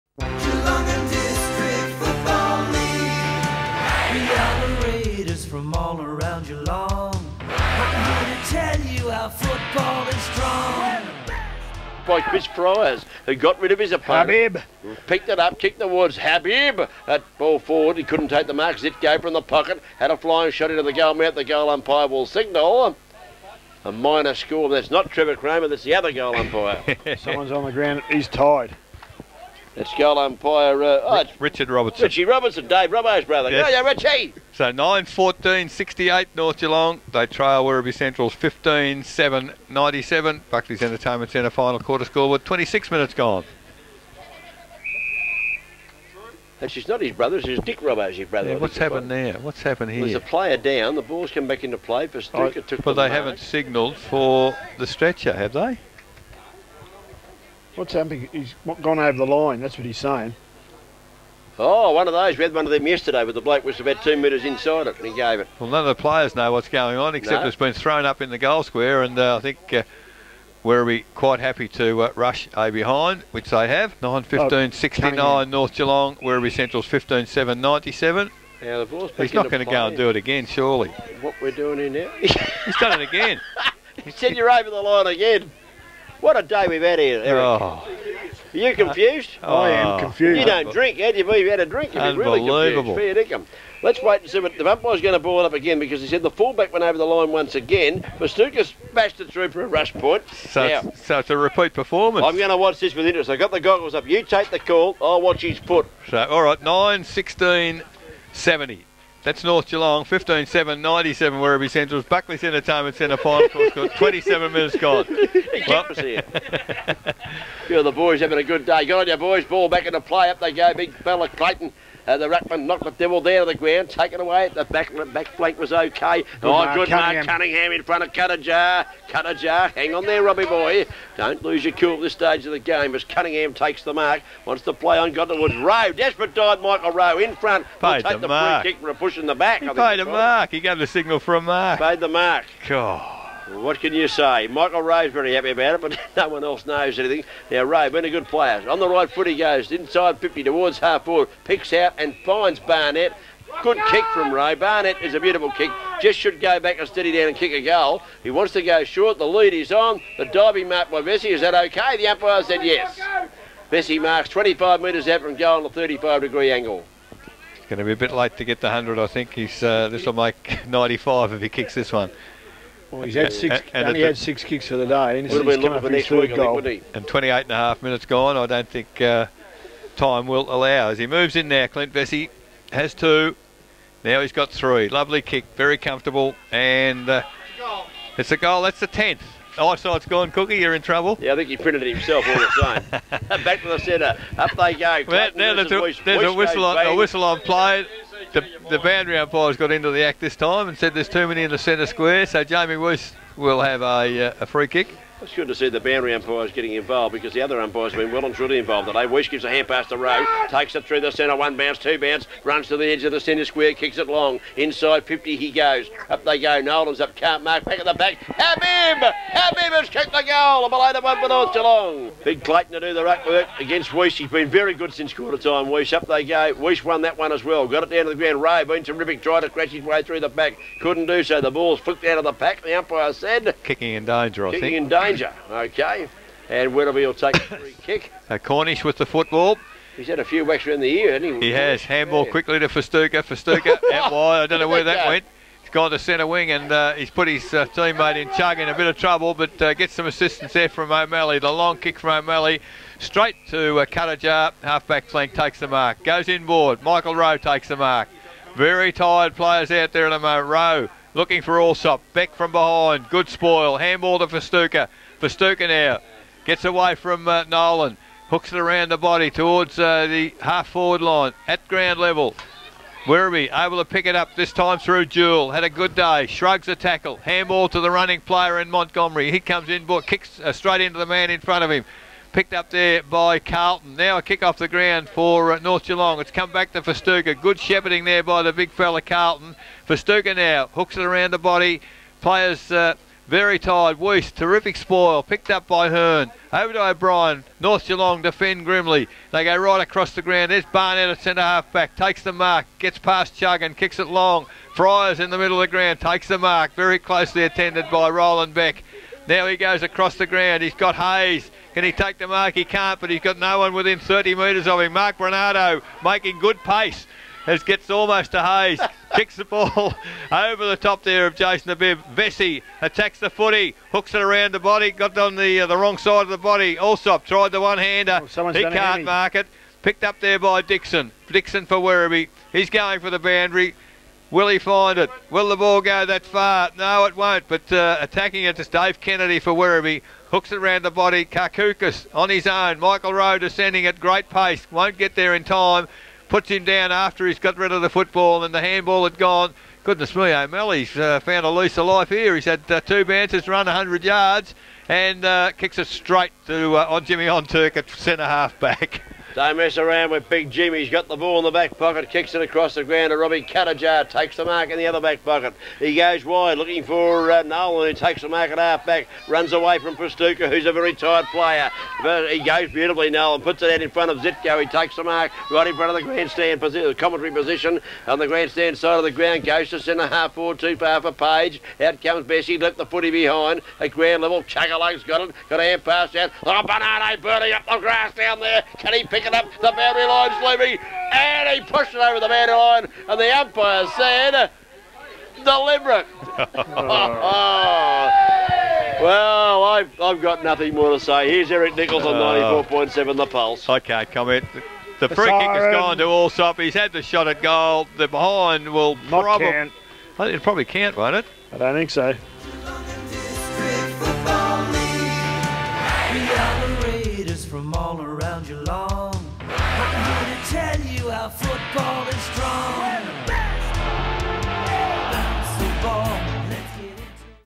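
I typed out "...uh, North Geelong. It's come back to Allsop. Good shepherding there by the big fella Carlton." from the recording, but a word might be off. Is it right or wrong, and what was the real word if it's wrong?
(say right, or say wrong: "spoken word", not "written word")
wrong: "Festuca", not "Allsop".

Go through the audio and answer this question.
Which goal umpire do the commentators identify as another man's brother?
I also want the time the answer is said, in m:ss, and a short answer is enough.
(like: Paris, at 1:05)
Richard Robertson, at 0:31.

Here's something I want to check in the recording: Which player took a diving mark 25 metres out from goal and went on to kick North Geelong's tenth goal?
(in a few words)
Clint Vesey.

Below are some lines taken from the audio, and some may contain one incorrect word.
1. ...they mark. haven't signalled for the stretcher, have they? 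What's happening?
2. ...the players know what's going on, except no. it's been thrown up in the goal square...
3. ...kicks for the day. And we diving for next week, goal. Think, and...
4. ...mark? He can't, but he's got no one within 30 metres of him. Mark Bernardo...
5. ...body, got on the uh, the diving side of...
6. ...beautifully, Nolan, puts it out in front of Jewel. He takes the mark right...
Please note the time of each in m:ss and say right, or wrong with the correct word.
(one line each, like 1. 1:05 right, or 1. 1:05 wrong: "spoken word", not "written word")
1. 0:52 right
2. 1:05 right
3. 2:54 wrong: "looking", not "diving"
4. 5:12 right
5. 5:24 wrong: "wrong", not "diving"
6. 6:12 wrong: "Zitko", not "Jewel".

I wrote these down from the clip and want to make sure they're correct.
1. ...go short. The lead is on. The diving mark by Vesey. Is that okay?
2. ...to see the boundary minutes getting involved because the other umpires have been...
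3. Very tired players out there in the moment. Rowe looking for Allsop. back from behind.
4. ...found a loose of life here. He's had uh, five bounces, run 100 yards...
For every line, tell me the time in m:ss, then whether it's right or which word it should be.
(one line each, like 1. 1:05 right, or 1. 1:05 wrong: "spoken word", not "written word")
1. 2:38 right
2. 3:25 wrong: "umpires", not "minutes"
3. 4:18 right
4. 5:51 wrong: "two", not "five".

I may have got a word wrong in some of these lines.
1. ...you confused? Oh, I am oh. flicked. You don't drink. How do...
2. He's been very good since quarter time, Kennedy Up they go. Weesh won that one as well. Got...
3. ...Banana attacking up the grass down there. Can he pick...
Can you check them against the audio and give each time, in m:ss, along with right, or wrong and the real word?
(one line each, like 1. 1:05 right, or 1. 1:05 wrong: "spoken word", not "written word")
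1. 1:28 wrong: "confused", not "flicked"
2. 3:44 wrong: "Weesh", not "Kennedy"
3. 6:26 wrong: "burning", not "attacking".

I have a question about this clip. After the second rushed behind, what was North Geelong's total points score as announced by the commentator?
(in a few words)
70.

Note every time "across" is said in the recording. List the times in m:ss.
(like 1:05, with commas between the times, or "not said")
4:59, 5:09, 6:02.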